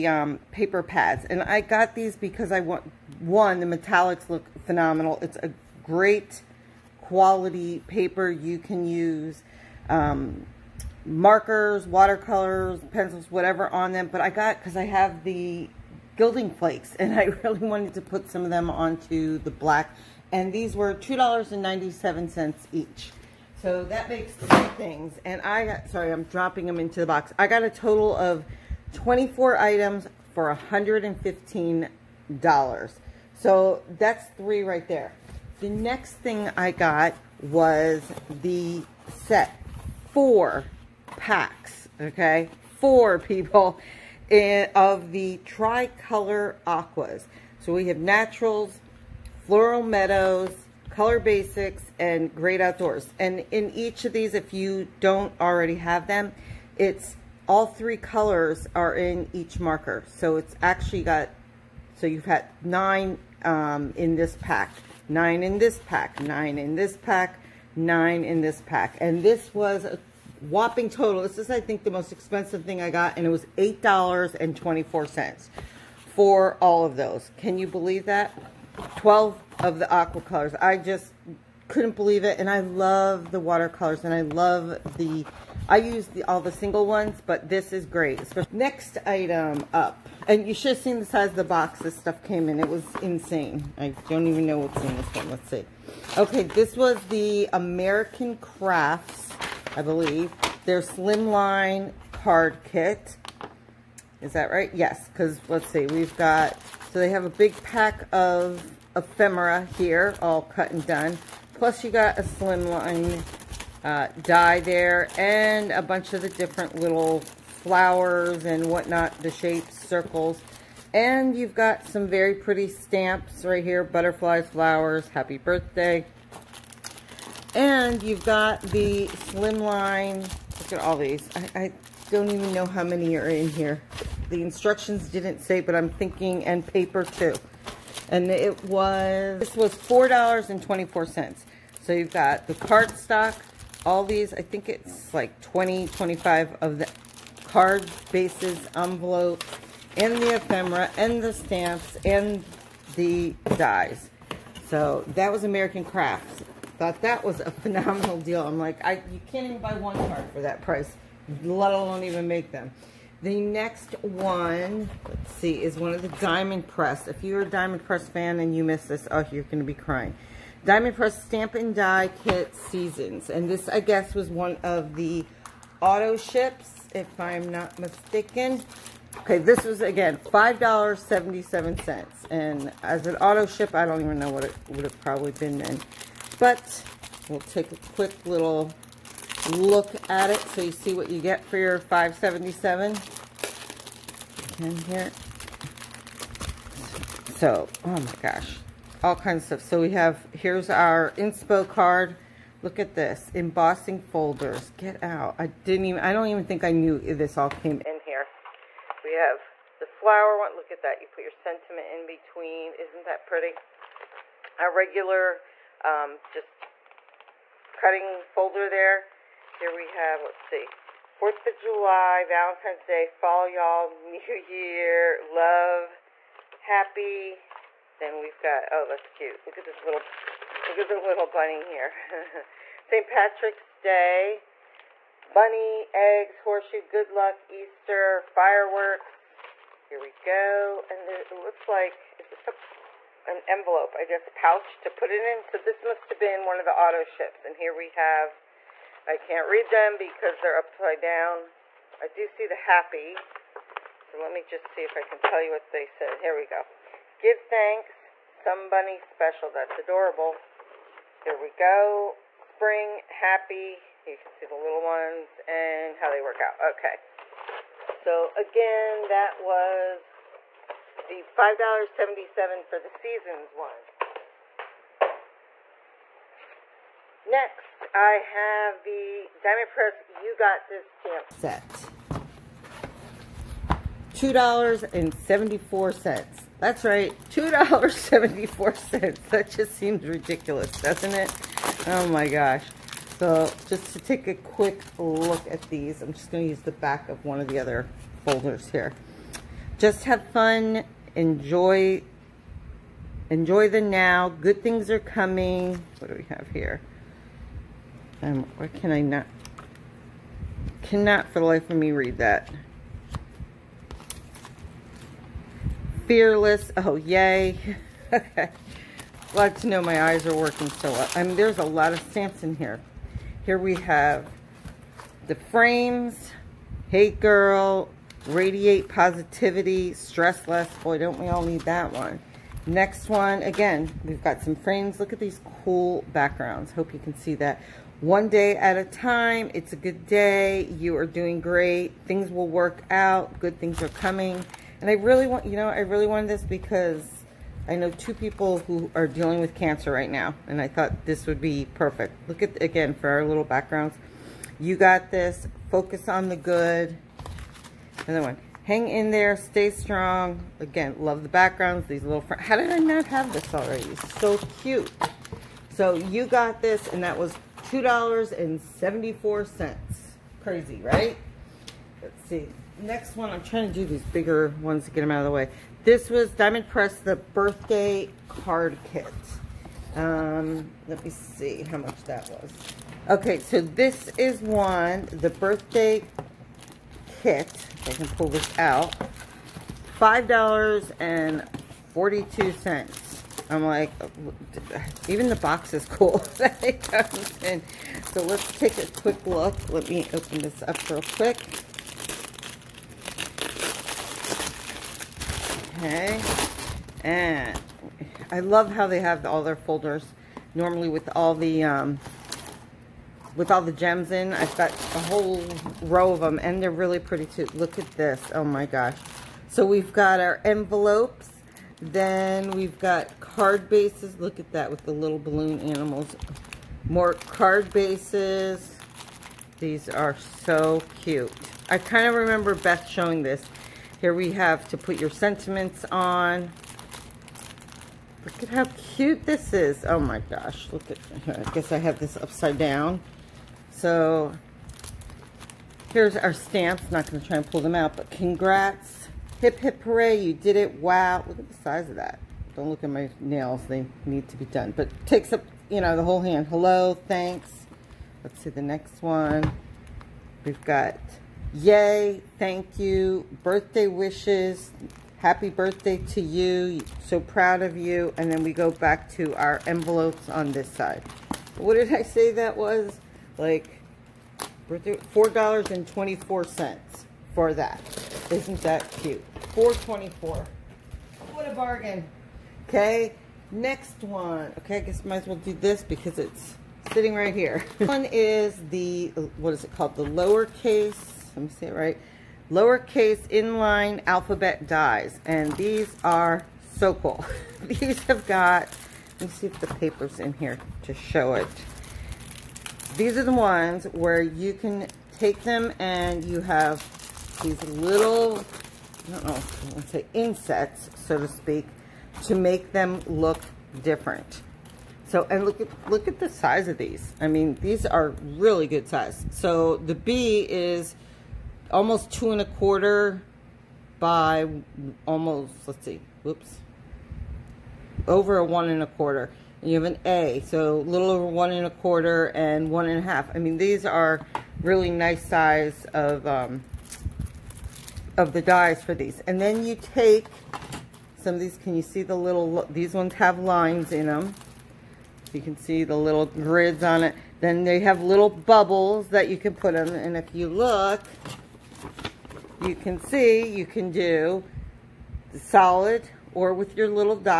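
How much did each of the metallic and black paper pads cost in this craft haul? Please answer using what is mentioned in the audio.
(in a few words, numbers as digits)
$2.97.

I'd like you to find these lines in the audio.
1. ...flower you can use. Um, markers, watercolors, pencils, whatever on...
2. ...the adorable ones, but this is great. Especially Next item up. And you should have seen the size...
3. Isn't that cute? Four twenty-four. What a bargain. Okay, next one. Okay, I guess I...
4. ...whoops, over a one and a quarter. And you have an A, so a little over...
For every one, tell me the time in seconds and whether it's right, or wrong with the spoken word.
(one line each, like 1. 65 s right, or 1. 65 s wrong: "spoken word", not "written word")
1. 7 s wrong: "paper", not "flower"
2. 86 s wrong: "single", not "adorable"
3. 478 s right
4. 526 s right.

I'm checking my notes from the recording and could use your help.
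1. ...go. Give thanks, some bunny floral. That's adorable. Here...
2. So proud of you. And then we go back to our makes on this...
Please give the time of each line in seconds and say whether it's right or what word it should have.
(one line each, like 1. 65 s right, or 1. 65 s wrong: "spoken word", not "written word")
1. 256 s wrong: "special", not "floral"
2. 467 s wrong: "envelopes", not "makes".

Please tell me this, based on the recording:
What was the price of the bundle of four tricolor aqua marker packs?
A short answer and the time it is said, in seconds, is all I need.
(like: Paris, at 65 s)
$8.24, at 73 s.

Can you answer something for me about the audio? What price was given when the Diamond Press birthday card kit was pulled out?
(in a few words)
$5.42.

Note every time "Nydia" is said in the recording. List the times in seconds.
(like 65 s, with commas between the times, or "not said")
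not said.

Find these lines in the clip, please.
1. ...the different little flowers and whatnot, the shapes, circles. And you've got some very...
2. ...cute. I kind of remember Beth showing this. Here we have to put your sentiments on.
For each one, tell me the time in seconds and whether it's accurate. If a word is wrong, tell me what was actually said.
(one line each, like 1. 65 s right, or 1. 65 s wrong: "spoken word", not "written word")
1. 116 s right
2. 431 s right.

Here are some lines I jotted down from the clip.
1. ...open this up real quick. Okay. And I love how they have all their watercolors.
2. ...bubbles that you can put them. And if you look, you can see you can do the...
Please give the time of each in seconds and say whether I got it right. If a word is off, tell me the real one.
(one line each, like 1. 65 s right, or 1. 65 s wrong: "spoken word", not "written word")
1. 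400 s wrong: "folders", not "watercolors"
2. 548 s right.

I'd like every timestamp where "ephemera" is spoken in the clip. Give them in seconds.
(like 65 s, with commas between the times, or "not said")
108 s, 150 s.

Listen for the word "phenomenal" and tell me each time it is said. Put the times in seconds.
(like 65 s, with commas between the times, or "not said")
4 s, 157 s.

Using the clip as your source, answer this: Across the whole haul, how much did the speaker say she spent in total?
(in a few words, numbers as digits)
$115.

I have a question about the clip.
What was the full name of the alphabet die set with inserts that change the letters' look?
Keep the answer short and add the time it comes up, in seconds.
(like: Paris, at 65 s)
lowercase inline alphabet dies, at 492 s.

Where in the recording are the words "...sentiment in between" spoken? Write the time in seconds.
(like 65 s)
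211 s.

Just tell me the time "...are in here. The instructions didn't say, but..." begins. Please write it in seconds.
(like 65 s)
133 s.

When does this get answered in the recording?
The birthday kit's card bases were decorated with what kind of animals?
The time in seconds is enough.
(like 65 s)
425 s.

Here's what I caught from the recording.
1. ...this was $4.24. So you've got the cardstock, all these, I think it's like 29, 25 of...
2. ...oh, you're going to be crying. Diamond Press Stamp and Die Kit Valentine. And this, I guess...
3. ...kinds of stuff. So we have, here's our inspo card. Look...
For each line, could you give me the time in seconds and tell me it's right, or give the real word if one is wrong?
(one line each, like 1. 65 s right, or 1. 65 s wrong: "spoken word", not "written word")
1. 139 s wrong: "20", not "29"
2. 169 s wrong: "Seasons", not "Valentine"
3. 199 s right.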